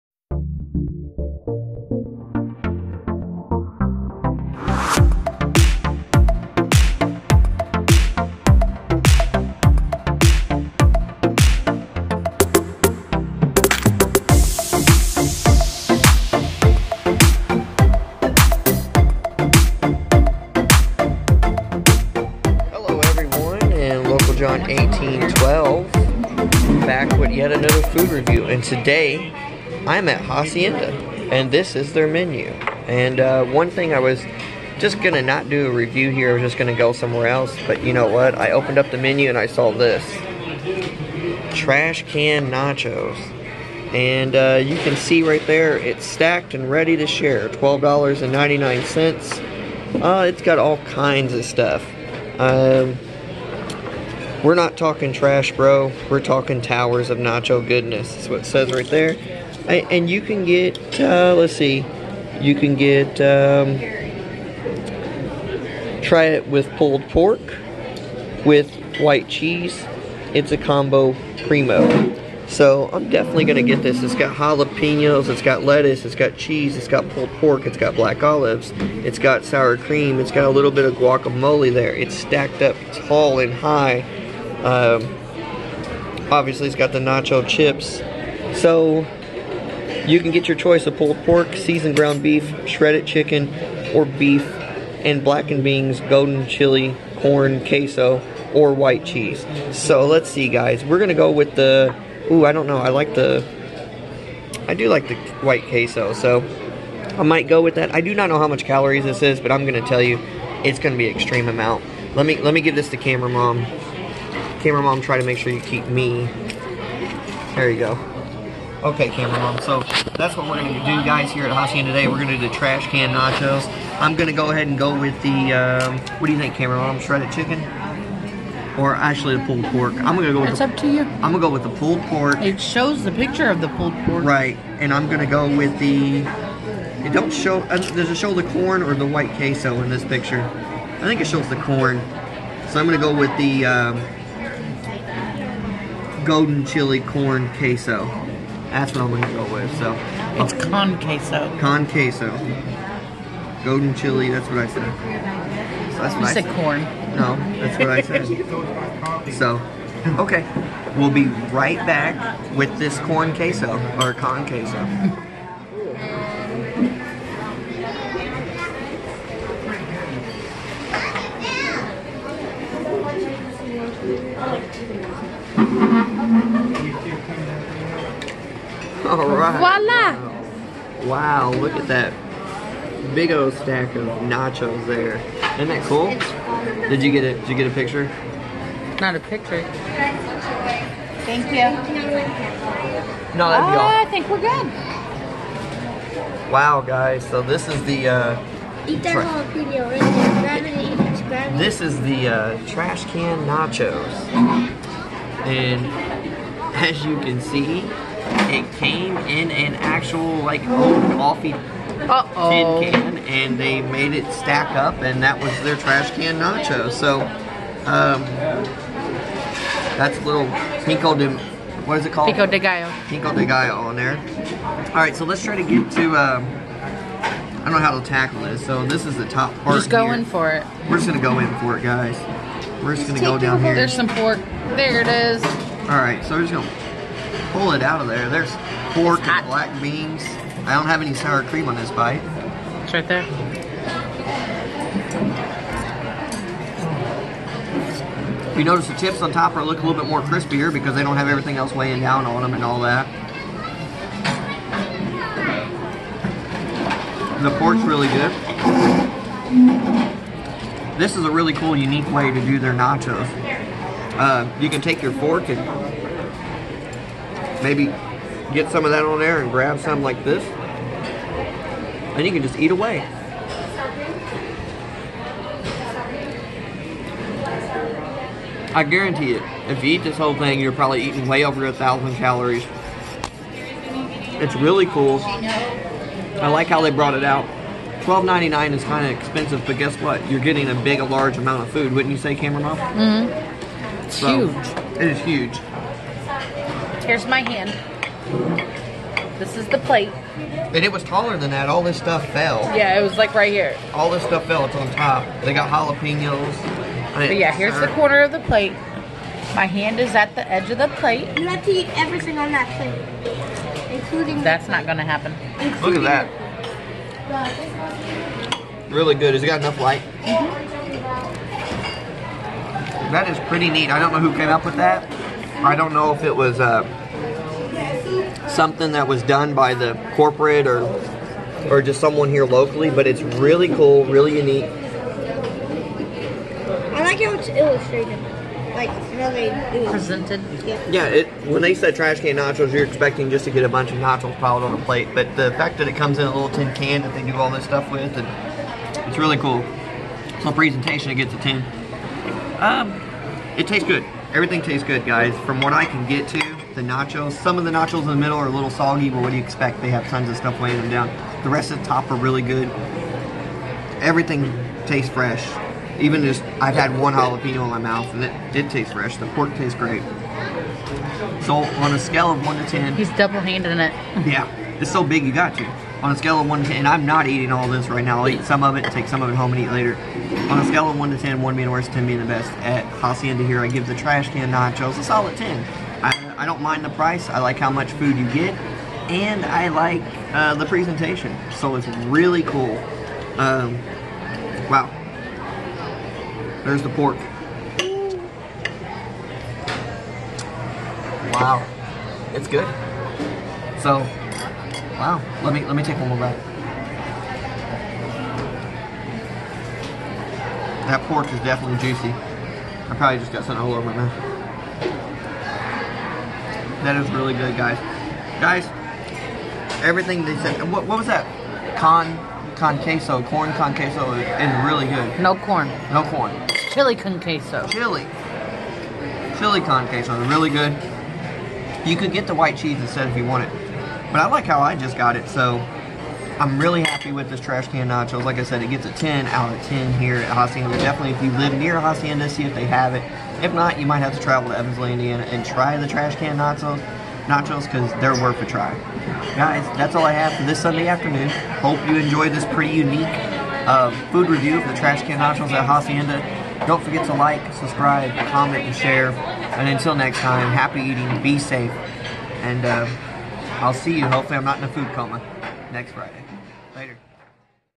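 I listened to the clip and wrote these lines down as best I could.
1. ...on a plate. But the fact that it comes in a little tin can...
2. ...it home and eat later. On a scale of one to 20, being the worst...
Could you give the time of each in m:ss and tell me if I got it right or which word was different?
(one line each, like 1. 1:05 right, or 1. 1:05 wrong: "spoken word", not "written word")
1. 5:44 right
2. 6:19 wrong: "10", not "20".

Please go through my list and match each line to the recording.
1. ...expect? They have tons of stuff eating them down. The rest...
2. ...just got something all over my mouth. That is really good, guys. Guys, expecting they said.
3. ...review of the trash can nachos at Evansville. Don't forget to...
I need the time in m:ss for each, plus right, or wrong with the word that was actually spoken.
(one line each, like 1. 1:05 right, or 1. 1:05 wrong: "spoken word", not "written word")
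1. 5:59 wrong: "weighing", not "eating"
2. 6:53 wrong: "everything", not "expecting"
3. 7:34 wrong: "Hacienda", not "Evansville".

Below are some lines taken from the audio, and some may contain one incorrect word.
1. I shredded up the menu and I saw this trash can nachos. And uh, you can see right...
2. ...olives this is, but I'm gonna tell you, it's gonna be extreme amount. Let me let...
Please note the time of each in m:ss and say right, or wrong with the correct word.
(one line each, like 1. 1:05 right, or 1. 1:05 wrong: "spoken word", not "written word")
1. 0:38 wrong: "opened", not "shredded"
2. 1:48 wrong: "calories", not "olives".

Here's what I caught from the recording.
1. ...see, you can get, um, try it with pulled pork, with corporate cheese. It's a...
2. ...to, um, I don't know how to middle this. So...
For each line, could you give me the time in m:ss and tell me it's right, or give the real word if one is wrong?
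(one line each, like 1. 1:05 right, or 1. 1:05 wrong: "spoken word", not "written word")
1. 1:01 wrong: "white", not "corporate"
2. 3:45 wrong: "tackle", not "middle".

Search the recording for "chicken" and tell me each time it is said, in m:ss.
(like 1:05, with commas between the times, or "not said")
1:33, 2:07.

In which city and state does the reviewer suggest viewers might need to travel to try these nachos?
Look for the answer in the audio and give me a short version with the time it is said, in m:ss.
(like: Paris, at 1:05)
Evansville, Indiana, at 7:24.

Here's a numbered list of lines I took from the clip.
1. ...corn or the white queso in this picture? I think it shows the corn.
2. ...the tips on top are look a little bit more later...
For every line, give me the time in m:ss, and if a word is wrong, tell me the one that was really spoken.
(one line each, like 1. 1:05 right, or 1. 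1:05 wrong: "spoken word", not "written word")
1. 2:18 right
2. 4:08 wrong: "crispier", not "later".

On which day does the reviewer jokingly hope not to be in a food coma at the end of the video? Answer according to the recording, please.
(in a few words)
Friday.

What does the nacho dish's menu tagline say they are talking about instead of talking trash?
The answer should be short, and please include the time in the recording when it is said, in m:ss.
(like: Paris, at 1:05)
Towers of nacho goodness, at 0:56.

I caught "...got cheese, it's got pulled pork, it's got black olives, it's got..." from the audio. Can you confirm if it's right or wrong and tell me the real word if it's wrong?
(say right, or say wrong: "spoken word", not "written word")
right.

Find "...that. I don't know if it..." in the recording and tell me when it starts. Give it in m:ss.
5:24.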